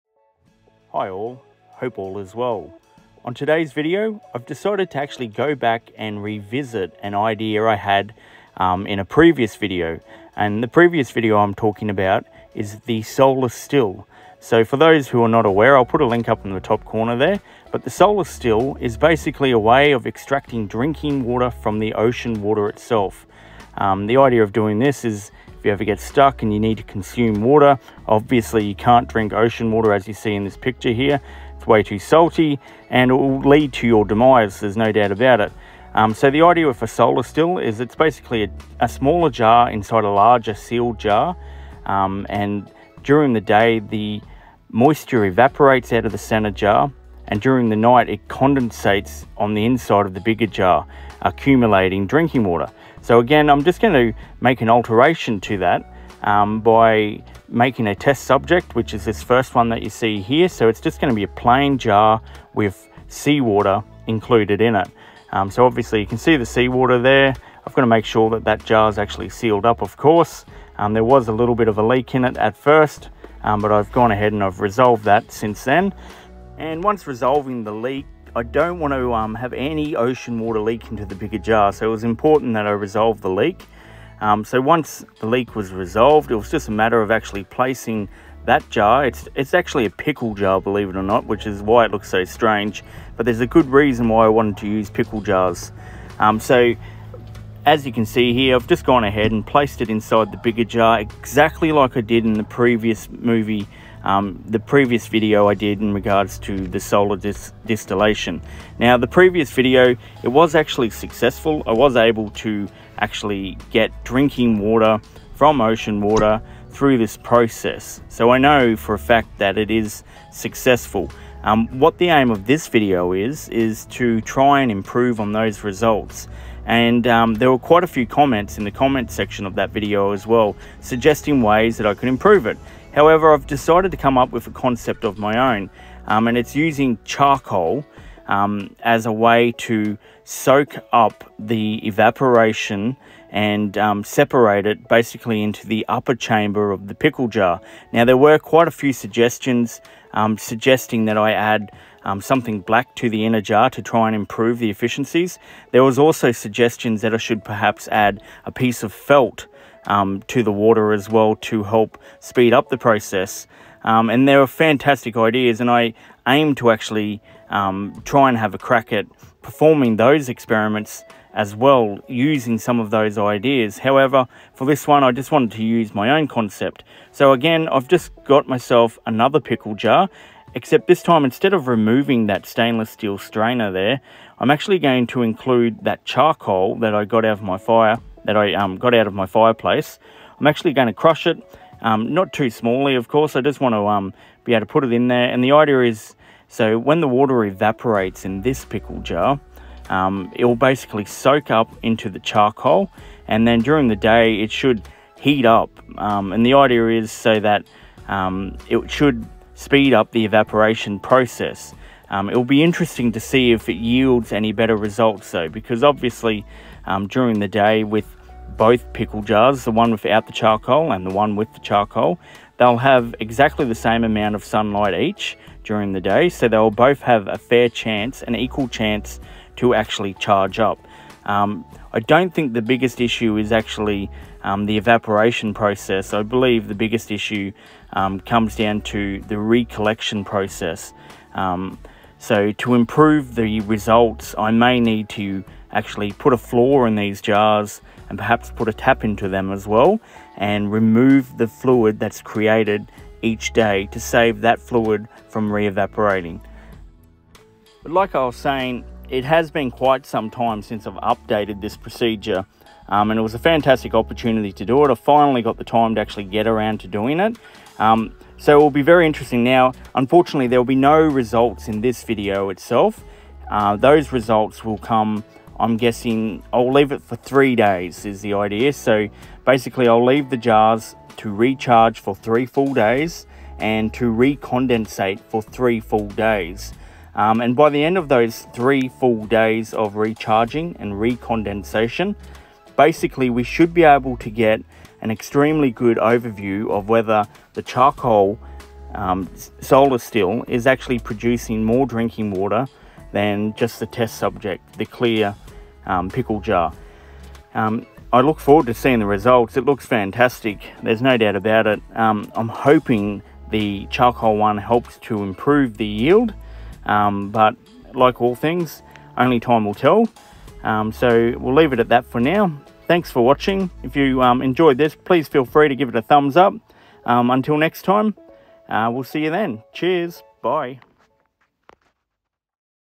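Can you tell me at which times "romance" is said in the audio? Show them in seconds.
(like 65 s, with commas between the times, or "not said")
not said.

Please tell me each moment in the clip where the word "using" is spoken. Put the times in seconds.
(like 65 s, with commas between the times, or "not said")
136 s, 172 s.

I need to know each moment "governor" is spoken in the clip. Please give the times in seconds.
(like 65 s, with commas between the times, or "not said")
not said.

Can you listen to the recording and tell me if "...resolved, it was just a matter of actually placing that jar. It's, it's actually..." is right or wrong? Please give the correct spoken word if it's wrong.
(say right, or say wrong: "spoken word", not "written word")
right.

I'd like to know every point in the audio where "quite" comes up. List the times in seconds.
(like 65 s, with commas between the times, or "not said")
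127 s, 148 s, 259 s.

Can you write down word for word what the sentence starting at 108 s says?
Now the previous video, it was actually successful.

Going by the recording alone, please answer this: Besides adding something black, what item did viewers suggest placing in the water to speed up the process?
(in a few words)
A piece of felt.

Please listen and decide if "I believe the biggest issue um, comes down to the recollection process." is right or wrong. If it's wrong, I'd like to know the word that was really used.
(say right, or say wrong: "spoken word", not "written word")
right.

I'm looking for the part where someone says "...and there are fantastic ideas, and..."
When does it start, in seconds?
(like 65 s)
164 s.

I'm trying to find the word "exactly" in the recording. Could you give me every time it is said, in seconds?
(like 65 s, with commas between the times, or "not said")
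100 s, 223 s.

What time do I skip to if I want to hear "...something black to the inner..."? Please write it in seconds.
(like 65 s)
152 s.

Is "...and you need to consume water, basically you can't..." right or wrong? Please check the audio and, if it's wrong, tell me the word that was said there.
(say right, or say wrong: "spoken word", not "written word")
wrong: "obviously", not "basically".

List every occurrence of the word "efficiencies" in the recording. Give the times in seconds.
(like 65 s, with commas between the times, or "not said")
154 s.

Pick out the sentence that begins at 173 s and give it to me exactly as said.
However, for this one, I just wanted to use my own concept.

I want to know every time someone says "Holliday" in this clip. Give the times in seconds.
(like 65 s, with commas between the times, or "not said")
not said.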